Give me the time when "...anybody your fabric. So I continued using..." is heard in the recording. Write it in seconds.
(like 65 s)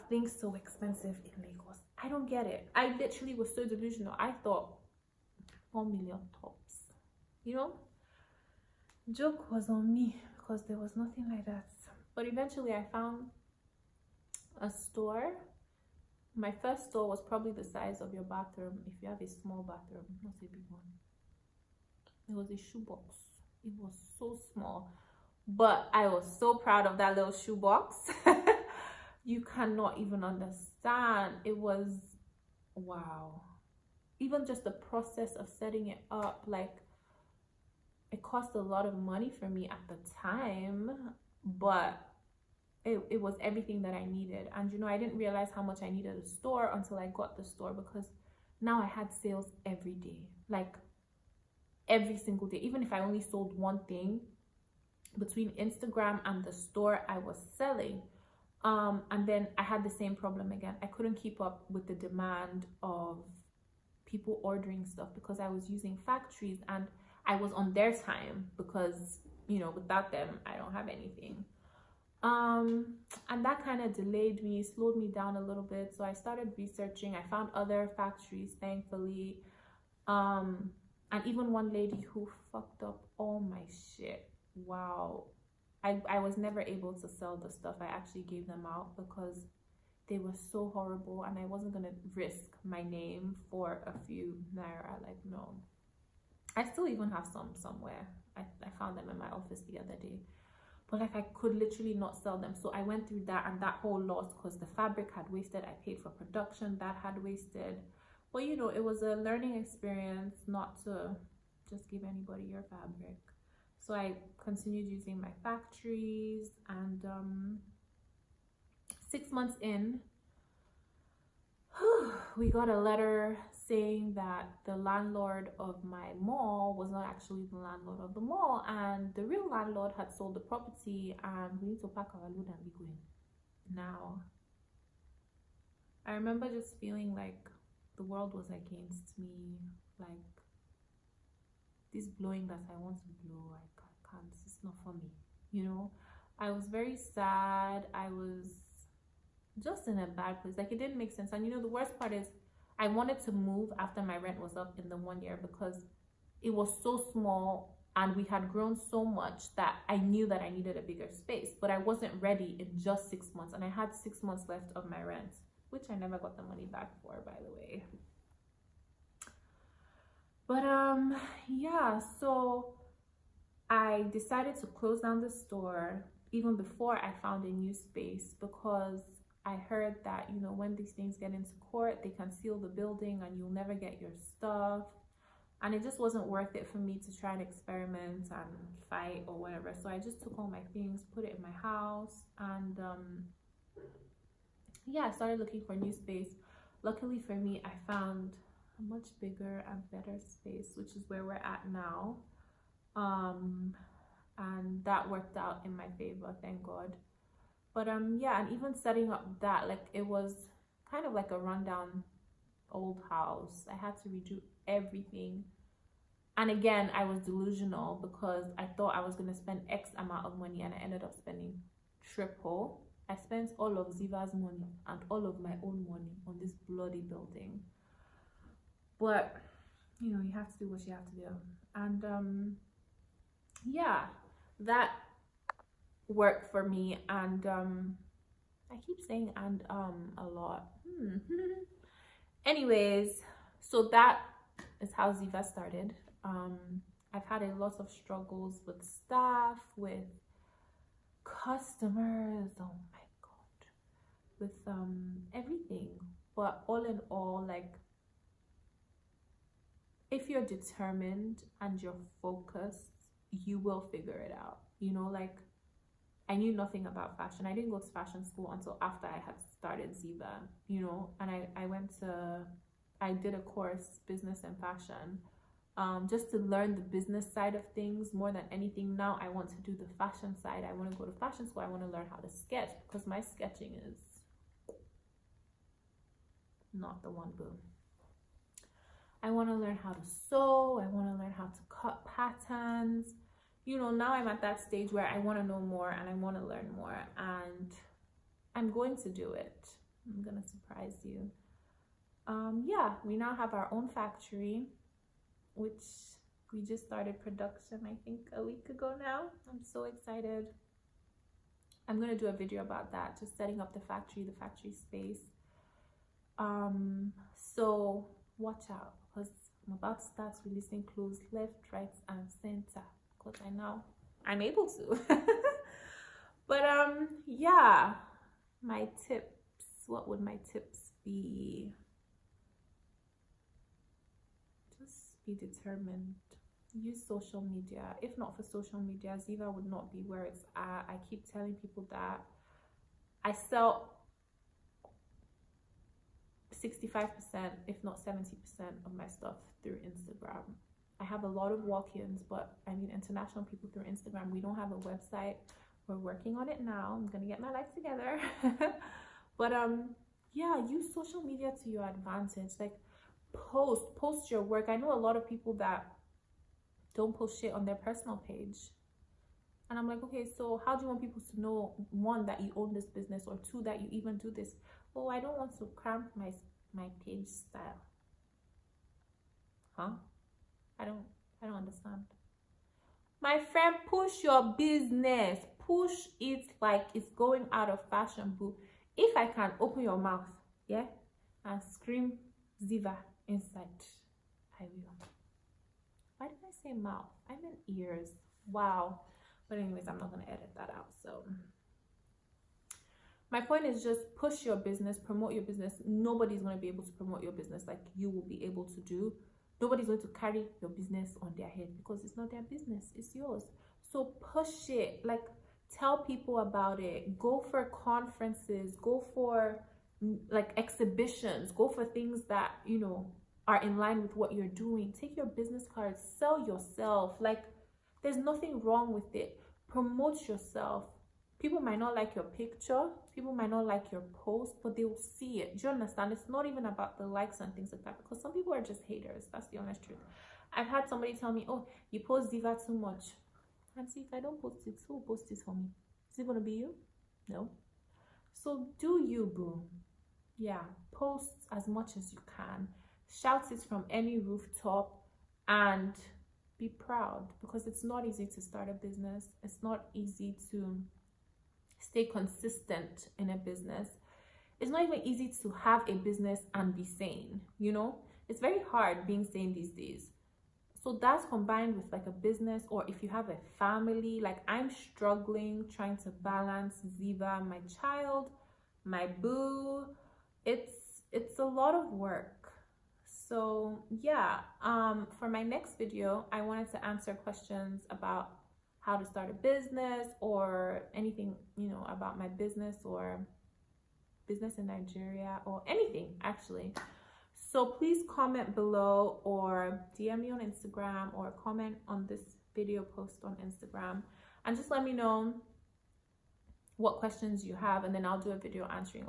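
112 s.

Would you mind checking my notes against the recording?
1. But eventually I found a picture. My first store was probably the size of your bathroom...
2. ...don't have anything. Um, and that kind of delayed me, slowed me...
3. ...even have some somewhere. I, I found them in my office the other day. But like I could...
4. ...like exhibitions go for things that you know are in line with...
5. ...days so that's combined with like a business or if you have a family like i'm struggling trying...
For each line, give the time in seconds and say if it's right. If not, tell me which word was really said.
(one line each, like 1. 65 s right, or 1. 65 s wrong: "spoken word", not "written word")
1. 12 s wrong: "store", not "picture"
2. 70 s right
3. 96 s right
4. 420 s right
5. 469 s right.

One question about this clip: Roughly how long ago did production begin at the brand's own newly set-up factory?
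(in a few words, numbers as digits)
a week.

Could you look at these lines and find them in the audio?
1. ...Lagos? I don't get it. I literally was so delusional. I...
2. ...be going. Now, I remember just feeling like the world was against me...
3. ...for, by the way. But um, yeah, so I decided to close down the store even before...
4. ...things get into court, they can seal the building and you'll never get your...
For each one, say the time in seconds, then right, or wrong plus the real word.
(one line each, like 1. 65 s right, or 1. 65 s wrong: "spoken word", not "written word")
1. 1 s right
2. 132 s right
3. 167 s right
4. 180 s right.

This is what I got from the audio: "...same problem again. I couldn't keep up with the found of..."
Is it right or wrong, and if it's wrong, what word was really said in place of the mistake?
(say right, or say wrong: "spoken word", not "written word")
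wrong: "demand", not "found".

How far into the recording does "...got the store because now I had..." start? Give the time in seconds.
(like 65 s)
47 s.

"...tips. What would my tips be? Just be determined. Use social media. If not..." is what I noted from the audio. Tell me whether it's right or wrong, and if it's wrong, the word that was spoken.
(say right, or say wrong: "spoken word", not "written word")
right.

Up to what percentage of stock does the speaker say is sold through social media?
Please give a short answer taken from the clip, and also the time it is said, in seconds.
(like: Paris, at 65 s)
70%, at 348 s.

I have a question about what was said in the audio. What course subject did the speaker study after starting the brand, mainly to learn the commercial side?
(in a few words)
business and fashion.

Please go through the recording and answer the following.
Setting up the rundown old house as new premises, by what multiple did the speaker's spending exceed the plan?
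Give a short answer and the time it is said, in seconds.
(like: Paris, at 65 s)
triple, at 222 s.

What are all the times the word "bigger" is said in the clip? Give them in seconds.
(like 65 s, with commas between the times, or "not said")
160 s, 199 s.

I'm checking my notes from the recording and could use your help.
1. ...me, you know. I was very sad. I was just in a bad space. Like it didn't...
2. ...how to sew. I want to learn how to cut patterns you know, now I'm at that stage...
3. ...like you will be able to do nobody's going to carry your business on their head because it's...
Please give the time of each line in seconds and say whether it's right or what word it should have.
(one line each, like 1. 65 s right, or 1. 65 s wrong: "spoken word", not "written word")
1. 144 s wrong: "place", not "space"
2. 289 s right
3. 407 s right.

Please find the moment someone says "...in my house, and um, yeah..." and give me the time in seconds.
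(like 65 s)
191 s.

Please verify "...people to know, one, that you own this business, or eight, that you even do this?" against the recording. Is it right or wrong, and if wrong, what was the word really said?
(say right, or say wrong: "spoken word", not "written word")
wrong: "two", not "eight".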